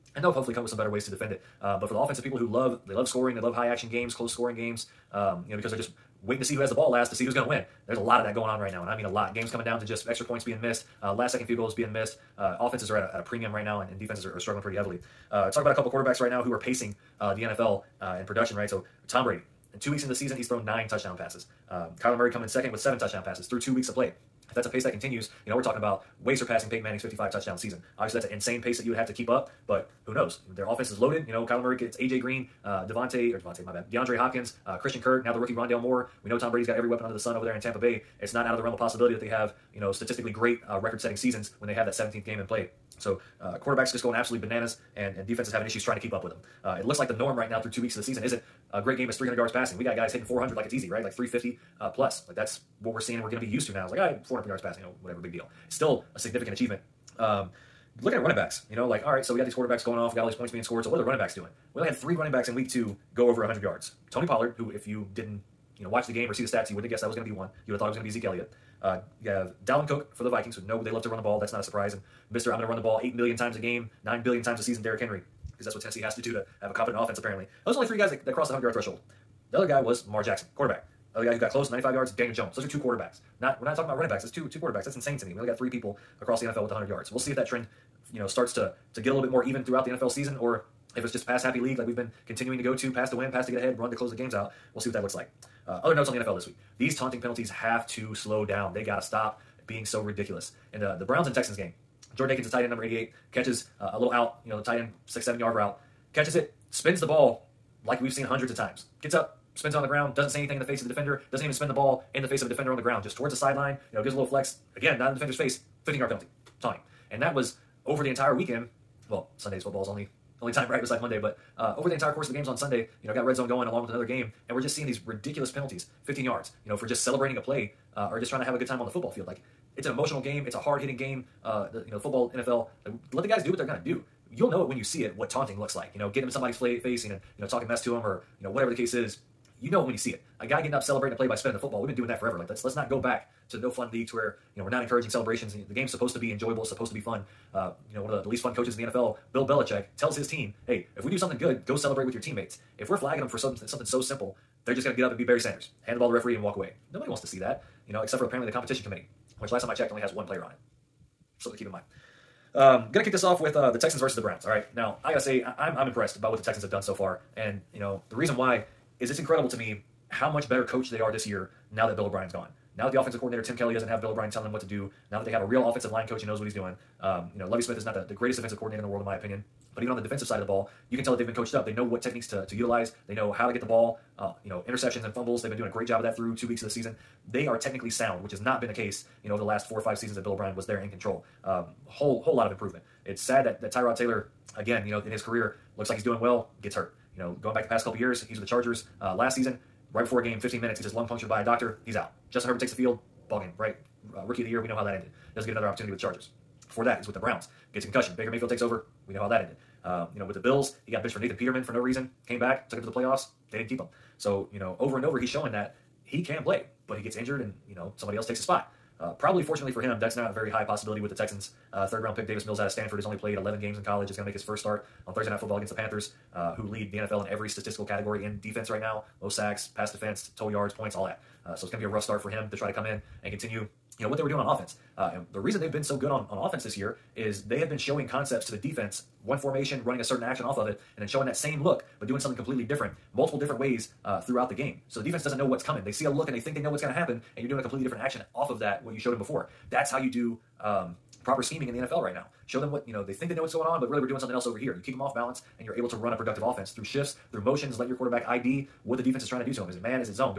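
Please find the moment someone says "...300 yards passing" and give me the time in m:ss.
0:49.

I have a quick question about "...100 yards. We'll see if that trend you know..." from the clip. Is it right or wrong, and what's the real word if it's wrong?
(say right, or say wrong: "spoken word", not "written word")
right.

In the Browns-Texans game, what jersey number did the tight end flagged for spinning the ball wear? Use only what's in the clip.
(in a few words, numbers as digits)
88.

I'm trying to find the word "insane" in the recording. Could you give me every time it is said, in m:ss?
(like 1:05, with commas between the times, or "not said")
0:28, 1:24.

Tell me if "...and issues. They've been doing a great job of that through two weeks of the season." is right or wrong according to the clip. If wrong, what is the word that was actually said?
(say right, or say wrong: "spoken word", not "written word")
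wrong: "fumbles", not "issues".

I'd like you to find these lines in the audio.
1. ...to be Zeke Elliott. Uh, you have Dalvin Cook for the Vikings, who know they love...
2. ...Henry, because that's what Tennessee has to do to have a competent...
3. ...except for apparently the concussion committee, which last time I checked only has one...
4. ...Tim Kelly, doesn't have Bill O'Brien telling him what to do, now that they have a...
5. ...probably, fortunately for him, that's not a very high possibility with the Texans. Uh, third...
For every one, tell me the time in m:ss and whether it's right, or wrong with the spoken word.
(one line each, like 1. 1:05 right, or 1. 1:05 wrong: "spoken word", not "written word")
1. 1:08 right
2. 1:14 right
3. 2:38 wrong: "competition", not "concussion"
4. 2:53 right
5. 3:39 right.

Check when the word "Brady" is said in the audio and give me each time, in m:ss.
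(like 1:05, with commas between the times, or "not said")
0:19, 0:36.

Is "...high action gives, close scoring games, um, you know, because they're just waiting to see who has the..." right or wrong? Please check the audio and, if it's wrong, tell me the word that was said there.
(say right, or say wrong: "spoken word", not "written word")
wrong: "games", not "gives".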